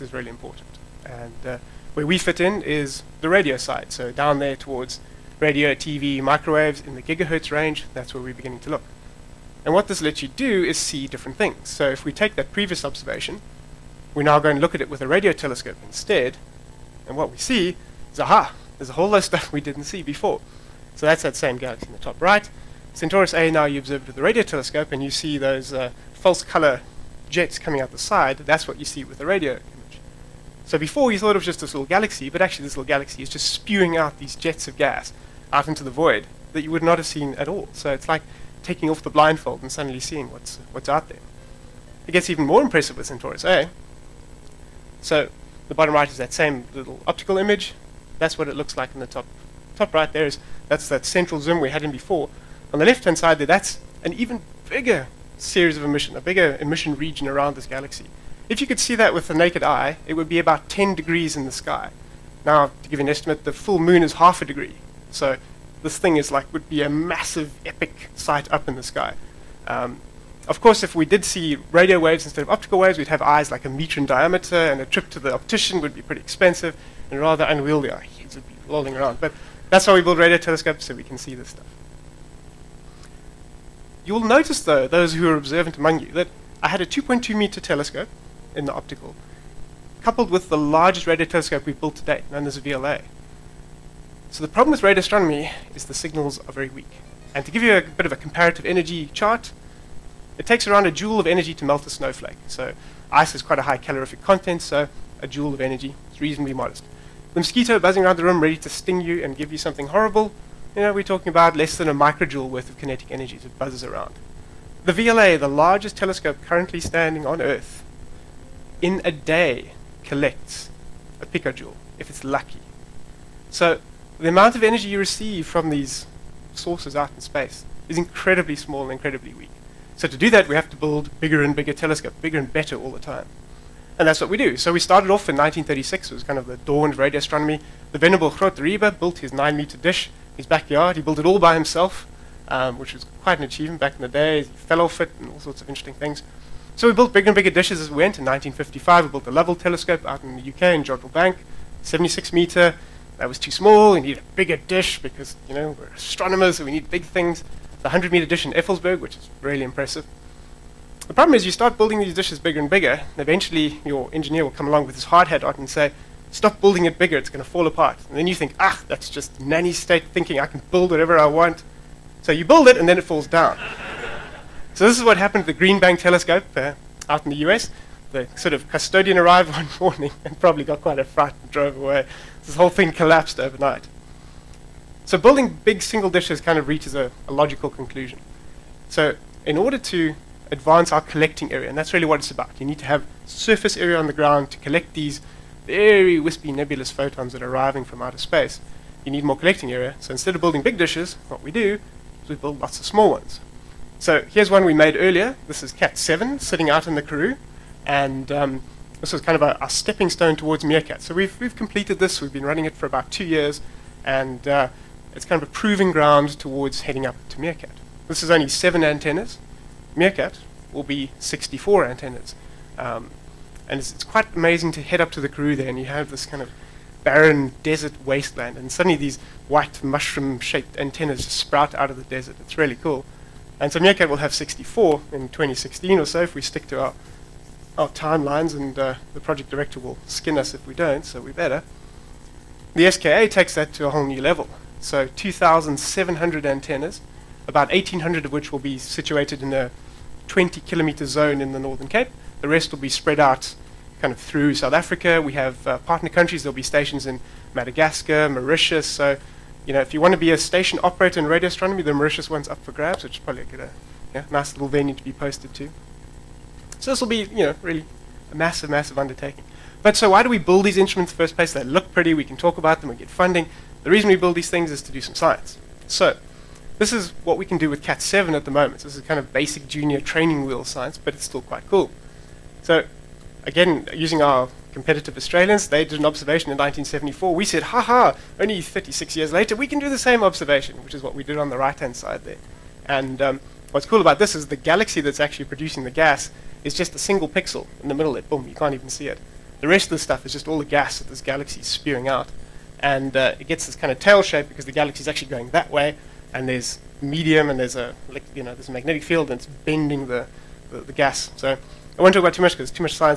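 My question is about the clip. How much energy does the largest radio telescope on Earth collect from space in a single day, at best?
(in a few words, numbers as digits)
a picojoule.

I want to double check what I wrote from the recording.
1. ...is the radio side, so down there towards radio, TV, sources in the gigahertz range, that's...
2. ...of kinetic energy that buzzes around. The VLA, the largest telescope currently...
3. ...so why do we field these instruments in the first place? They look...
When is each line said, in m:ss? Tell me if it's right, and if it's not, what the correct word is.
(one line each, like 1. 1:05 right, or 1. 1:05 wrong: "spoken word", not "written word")
1. 0:02 wrong: "microwaves", not "sources"
2. 1:52 right
3. 4:29 wrong: "build", not "field".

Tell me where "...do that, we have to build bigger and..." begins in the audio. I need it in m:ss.
2:10.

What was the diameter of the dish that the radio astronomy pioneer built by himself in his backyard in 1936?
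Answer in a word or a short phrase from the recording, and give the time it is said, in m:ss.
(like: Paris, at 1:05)
9 meters, at 2:19.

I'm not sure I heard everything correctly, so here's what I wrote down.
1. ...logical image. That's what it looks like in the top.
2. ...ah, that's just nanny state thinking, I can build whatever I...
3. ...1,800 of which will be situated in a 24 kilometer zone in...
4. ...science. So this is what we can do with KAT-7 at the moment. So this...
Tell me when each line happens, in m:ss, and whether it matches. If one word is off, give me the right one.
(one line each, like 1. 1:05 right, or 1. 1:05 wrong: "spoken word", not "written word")
1. 0:47 wrong: "optical", not "logical"
2. 2:48 right
3. 4:07 wrong: "20", not "24"
4. 4:35 right.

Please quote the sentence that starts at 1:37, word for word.
And to give you a bit of a comparative energy chart, it takes around a joule of energy to melt a snowflake.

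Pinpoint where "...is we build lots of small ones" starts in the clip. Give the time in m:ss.
3:22.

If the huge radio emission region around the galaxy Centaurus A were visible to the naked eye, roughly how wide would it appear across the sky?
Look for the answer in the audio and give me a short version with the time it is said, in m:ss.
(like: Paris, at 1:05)
10 degrees, at 1:00.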